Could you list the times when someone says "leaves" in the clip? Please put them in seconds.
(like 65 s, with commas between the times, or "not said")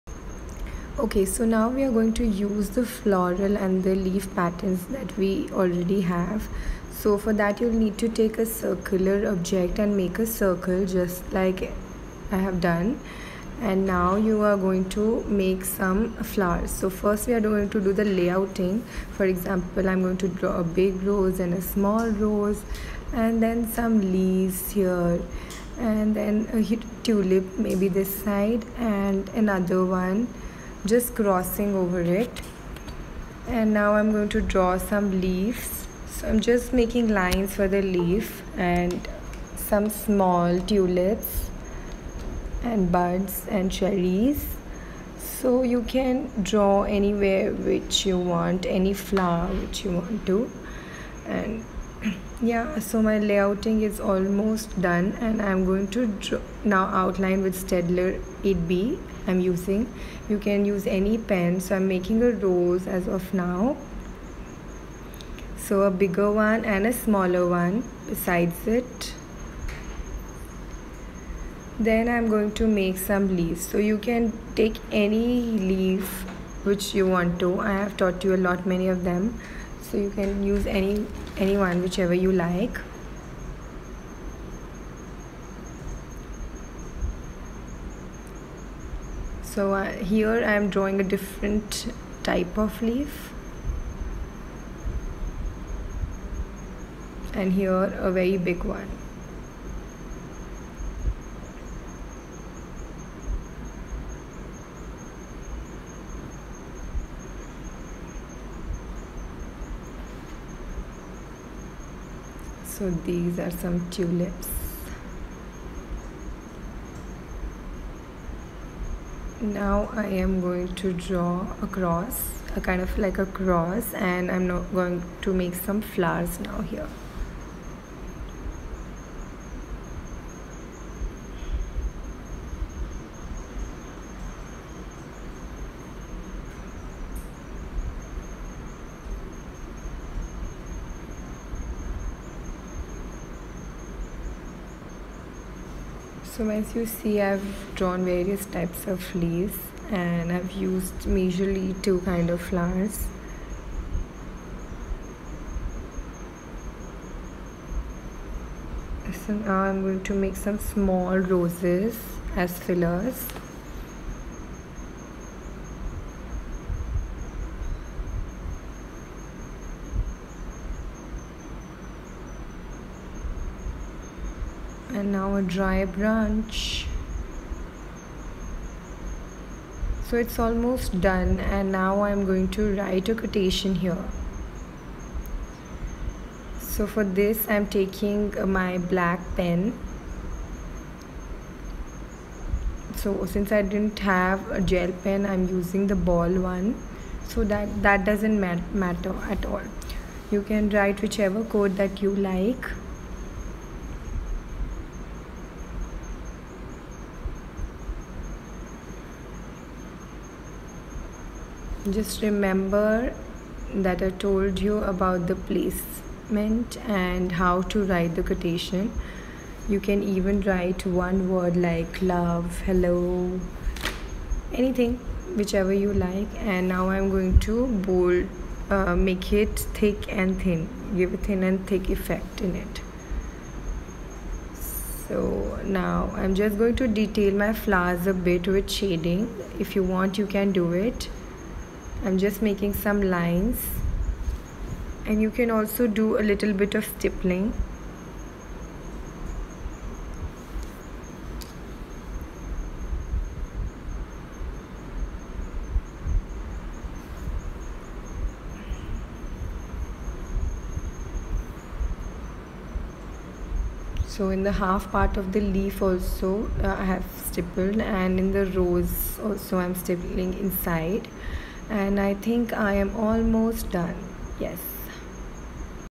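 24 s, 35 s, 73 s, 149 s.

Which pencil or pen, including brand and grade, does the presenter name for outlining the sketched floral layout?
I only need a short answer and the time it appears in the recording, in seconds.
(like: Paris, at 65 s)
Staedtler 8B, at 57 s.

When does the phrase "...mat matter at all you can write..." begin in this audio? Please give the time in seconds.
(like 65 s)
198 s.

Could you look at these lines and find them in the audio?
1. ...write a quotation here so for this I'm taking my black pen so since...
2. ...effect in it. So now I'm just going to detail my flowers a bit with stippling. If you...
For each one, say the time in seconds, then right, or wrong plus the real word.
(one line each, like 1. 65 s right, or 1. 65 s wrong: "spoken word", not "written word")
1. 182 s right
2. 231 s wrong: "shading", not "stippling".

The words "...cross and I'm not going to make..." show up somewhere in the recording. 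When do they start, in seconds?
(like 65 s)
123 s.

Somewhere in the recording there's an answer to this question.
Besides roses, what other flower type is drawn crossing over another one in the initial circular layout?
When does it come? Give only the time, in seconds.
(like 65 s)
27 s.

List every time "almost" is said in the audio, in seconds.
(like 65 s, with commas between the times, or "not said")
53 s, 180 s, 272 s.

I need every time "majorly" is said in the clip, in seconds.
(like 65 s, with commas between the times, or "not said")
151 s.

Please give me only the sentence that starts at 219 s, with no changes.
You can even write one word like love, hello, anything, whichever you like.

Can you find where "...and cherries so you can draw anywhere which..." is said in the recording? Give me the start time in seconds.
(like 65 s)
43 s.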